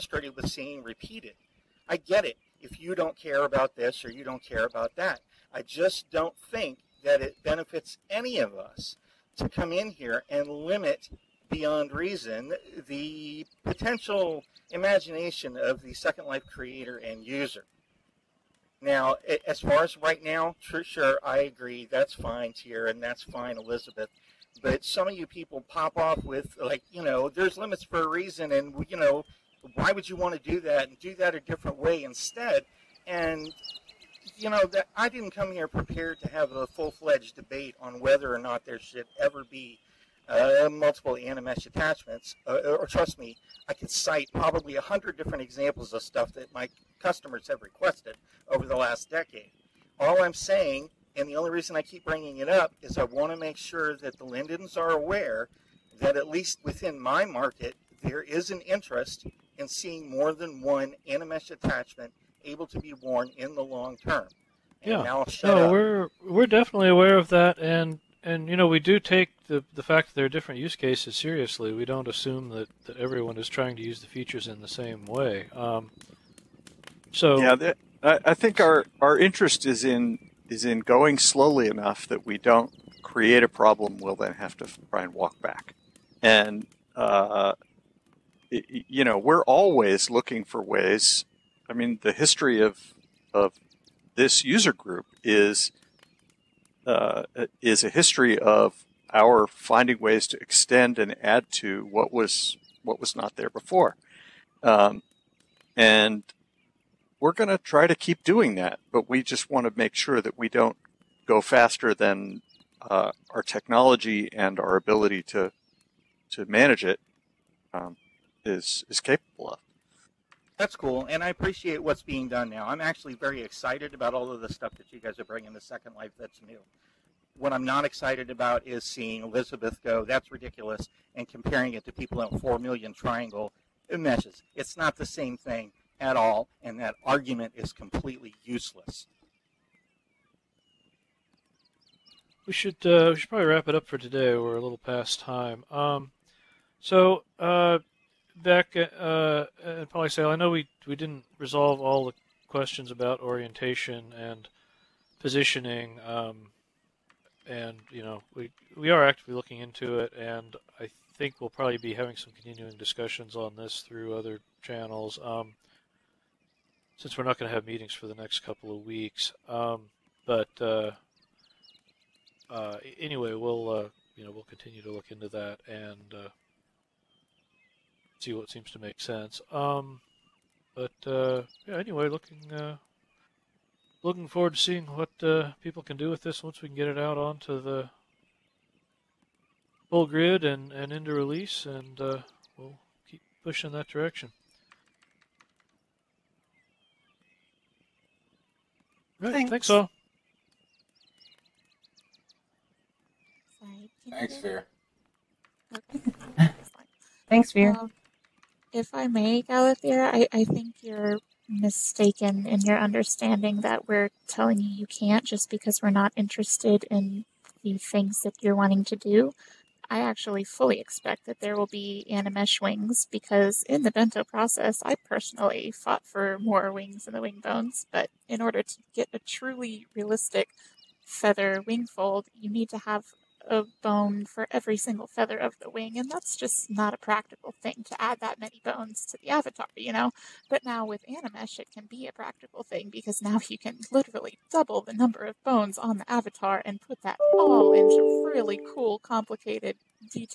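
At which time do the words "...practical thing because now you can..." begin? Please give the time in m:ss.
4:02.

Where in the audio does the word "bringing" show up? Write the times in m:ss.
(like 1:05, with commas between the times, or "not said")
0:52, 2:05.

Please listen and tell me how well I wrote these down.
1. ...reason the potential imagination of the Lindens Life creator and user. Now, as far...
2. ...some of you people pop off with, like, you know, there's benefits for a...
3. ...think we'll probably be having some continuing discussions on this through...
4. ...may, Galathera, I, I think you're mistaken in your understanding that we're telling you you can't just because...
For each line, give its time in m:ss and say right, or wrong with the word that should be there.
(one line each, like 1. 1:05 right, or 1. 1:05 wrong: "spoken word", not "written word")
1. 0:11 wrong: "Second", not "Lindens"
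2. 0:24 wrong: "limits", not "benefits"
3. 2:41 right
4. 3:29 right.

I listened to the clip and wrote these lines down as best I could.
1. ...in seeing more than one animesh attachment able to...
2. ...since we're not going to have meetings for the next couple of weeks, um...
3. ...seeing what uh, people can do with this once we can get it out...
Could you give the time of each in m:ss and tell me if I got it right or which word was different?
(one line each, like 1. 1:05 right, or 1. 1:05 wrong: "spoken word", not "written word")
1. 0:59 right
2. 2:46 right
3. 3:04 right.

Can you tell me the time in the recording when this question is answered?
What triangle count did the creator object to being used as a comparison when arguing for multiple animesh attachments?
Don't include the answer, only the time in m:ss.
2:12.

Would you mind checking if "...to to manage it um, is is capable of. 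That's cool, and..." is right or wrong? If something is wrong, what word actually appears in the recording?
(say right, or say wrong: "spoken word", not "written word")
right.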